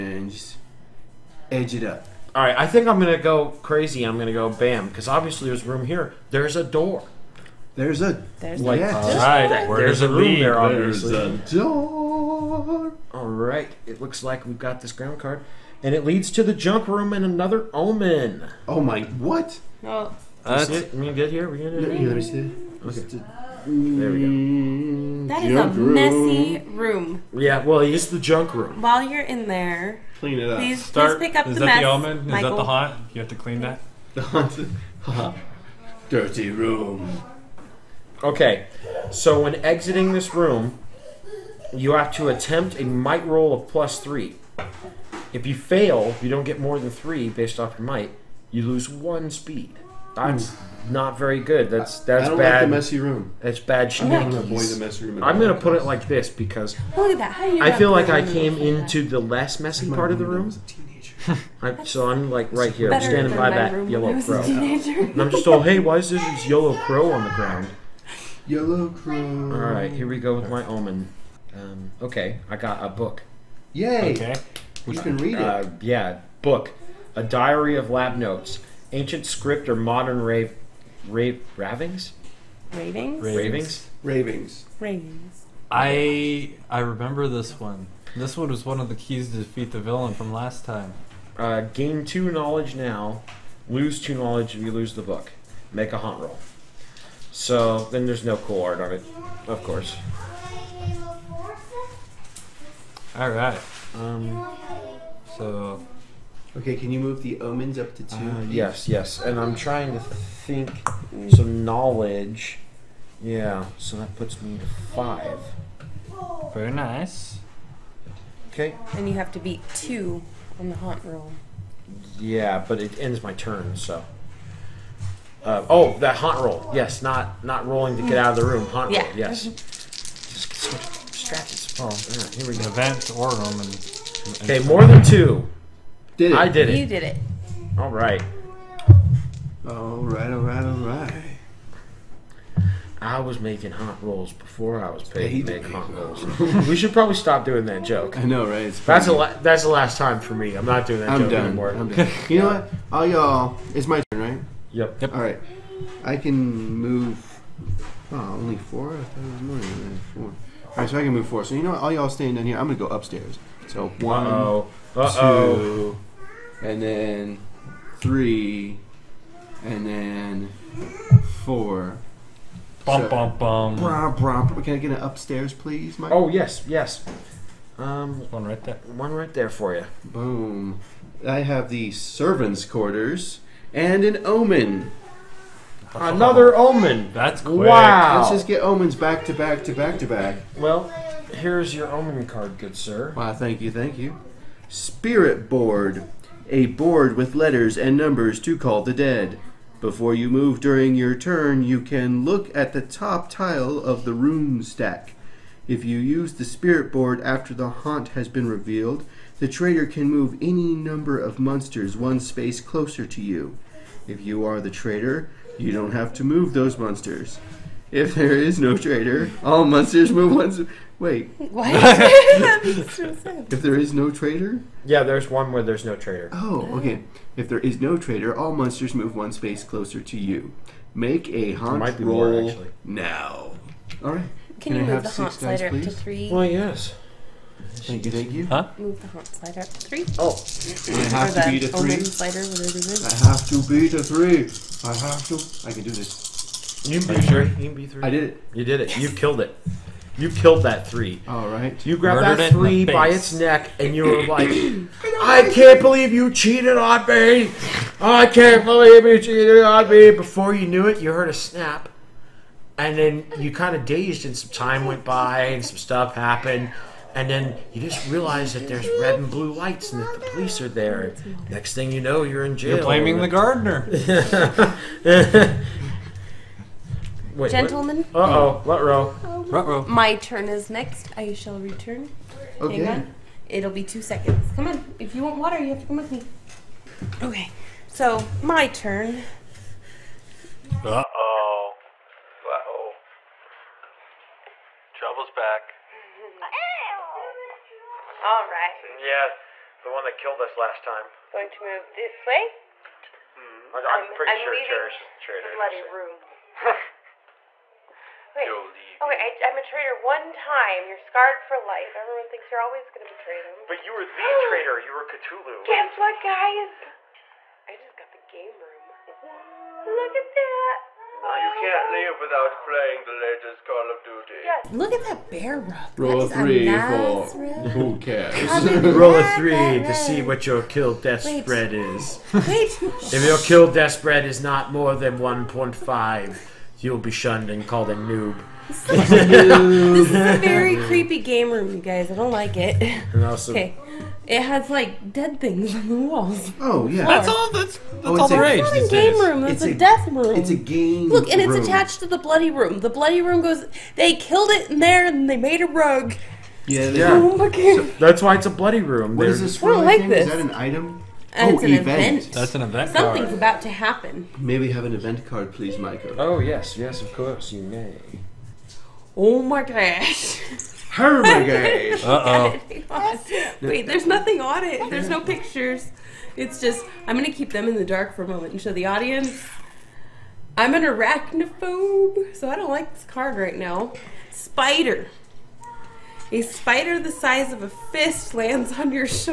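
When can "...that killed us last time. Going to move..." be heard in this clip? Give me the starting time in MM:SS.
05:00.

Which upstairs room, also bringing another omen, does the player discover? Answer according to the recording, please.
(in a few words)
servants' quarters.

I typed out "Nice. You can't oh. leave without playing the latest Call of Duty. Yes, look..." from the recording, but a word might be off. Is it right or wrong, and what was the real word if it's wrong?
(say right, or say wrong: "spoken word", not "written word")
right.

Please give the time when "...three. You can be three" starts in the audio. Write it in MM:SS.
04:07.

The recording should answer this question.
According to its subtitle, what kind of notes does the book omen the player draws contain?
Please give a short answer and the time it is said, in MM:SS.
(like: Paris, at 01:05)
A diary of lab notes, at 01:17.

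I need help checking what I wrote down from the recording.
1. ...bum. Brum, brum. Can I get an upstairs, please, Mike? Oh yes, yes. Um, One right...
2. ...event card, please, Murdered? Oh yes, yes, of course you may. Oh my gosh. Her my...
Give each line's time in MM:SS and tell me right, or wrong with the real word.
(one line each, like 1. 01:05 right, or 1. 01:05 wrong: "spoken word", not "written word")
1. 02:53 right
2. 06:04 wrong: "Michael", not "Murdered".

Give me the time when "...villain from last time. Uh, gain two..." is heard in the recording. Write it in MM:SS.
01:29.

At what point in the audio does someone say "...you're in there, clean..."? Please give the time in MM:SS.
00:29.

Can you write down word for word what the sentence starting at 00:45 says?
If you fail, you don't get more than three based off your might.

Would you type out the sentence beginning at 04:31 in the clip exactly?
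Next thing you know, you're in jail.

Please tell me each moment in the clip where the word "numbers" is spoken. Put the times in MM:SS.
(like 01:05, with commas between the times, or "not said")
03:17, 03:30.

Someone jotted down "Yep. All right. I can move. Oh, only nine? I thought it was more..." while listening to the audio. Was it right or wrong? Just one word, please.
wrong.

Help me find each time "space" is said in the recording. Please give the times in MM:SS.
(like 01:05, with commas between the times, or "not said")
03:32, 03:49.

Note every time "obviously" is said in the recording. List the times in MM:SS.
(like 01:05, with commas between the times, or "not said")
00:05, 00:10.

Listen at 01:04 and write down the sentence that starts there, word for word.
And I'm just all, hey, why is this yellow crow on the ground?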